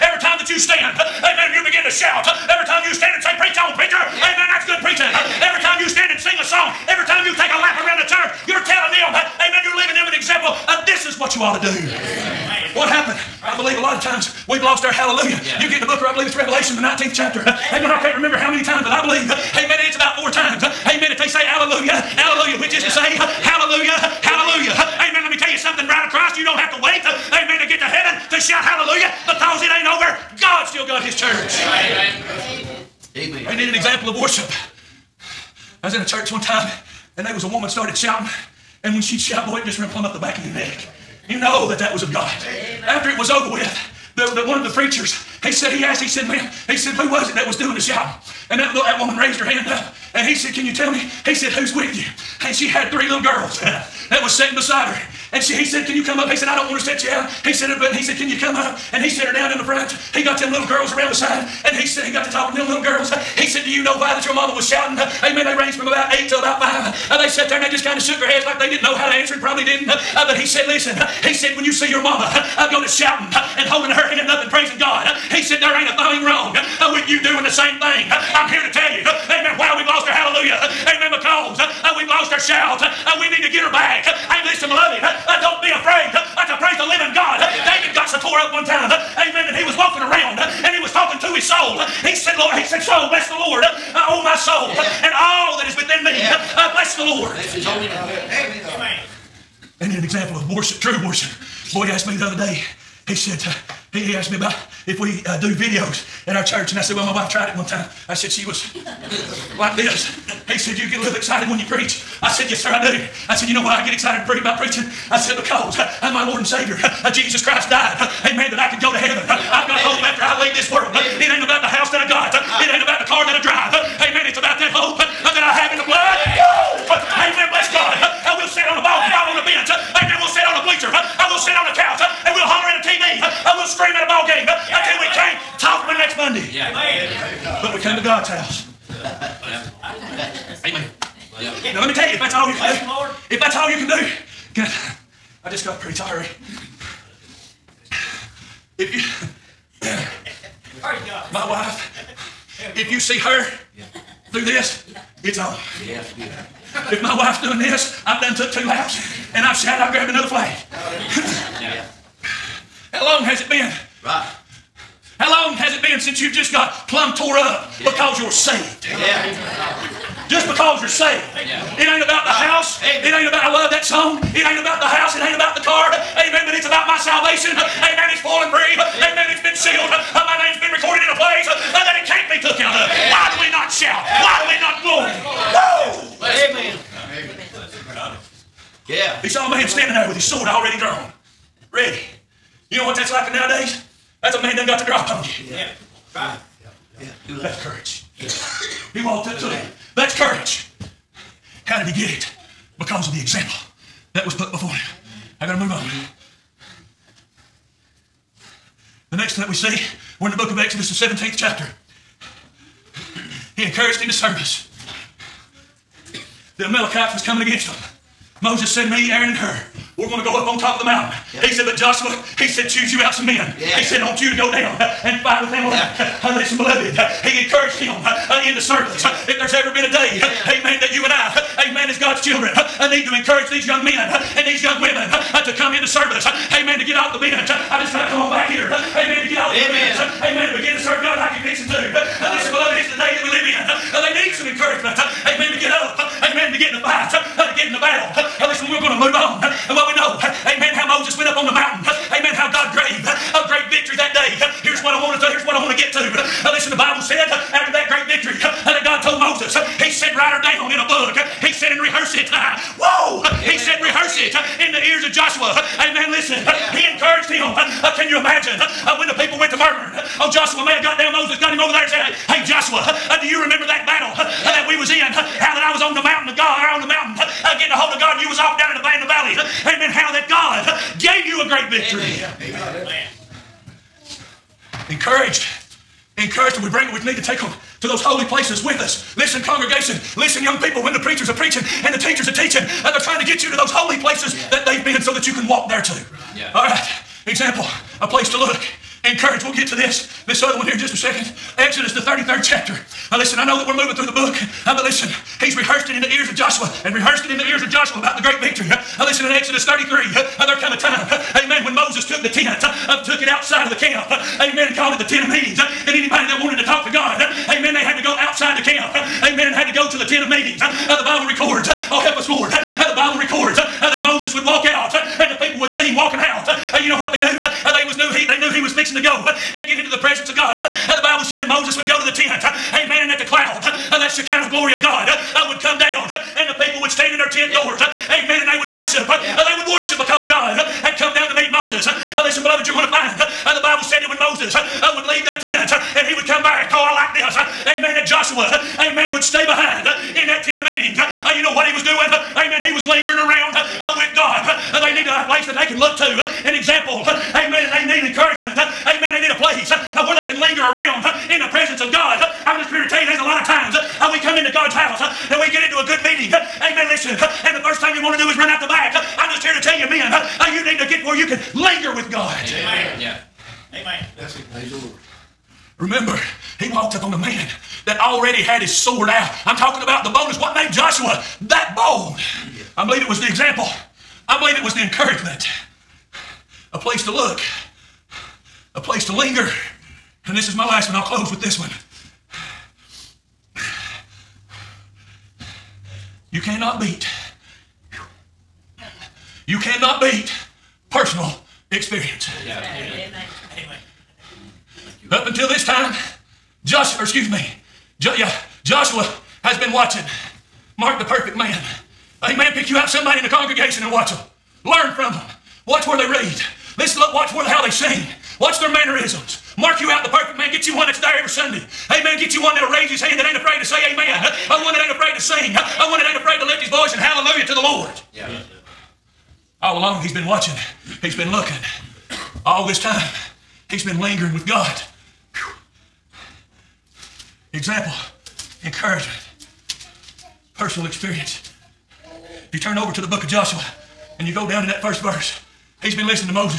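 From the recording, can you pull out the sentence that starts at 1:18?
I'm here to tell you, amen, why we've lost our hallelujah.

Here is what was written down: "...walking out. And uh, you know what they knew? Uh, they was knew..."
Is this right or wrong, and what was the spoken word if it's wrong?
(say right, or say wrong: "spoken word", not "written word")
right.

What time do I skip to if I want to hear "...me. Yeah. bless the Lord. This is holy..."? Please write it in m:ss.
1:36.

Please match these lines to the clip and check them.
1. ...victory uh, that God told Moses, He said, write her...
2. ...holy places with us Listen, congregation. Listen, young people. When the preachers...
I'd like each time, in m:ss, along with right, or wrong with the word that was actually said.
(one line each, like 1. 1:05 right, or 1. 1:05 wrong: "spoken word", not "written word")
1. 4:18 right
2. 4:48 right.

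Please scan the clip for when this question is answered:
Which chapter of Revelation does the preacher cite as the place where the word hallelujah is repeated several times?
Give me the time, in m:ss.
0:16.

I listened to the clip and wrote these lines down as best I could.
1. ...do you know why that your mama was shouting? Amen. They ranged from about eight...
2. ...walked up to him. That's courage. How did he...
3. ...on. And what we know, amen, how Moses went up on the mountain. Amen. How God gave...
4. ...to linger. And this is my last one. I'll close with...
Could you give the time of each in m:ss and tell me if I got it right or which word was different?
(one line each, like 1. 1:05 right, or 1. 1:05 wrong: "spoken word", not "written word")
1. 1:03 right
2. 3:19 right
3. 4:09 right
4. 6:29 right.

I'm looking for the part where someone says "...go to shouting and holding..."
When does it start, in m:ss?
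1:12.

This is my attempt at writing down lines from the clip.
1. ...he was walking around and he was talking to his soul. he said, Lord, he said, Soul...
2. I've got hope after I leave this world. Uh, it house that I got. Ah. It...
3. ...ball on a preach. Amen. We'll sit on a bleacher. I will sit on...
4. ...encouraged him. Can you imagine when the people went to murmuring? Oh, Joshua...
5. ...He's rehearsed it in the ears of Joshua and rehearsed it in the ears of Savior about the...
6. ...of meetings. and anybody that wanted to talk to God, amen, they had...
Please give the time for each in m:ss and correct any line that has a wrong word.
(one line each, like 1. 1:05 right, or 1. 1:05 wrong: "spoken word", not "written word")
1. 1:29 right
2. 1:59 right
3. 2:09 wrong: "bench", not "preach"
4. 4:26 right
5. 5:05 wrong: "Joshua", not "Savior"
6. 5:15 right.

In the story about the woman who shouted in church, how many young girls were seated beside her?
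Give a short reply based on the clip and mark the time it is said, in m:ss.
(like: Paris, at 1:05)
3, at 0:52.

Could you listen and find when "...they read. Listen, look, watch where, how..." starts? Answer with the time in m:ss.
6:55.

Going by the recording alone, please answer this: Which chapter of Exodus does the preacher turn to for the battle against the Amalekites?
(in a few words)
17th chapter.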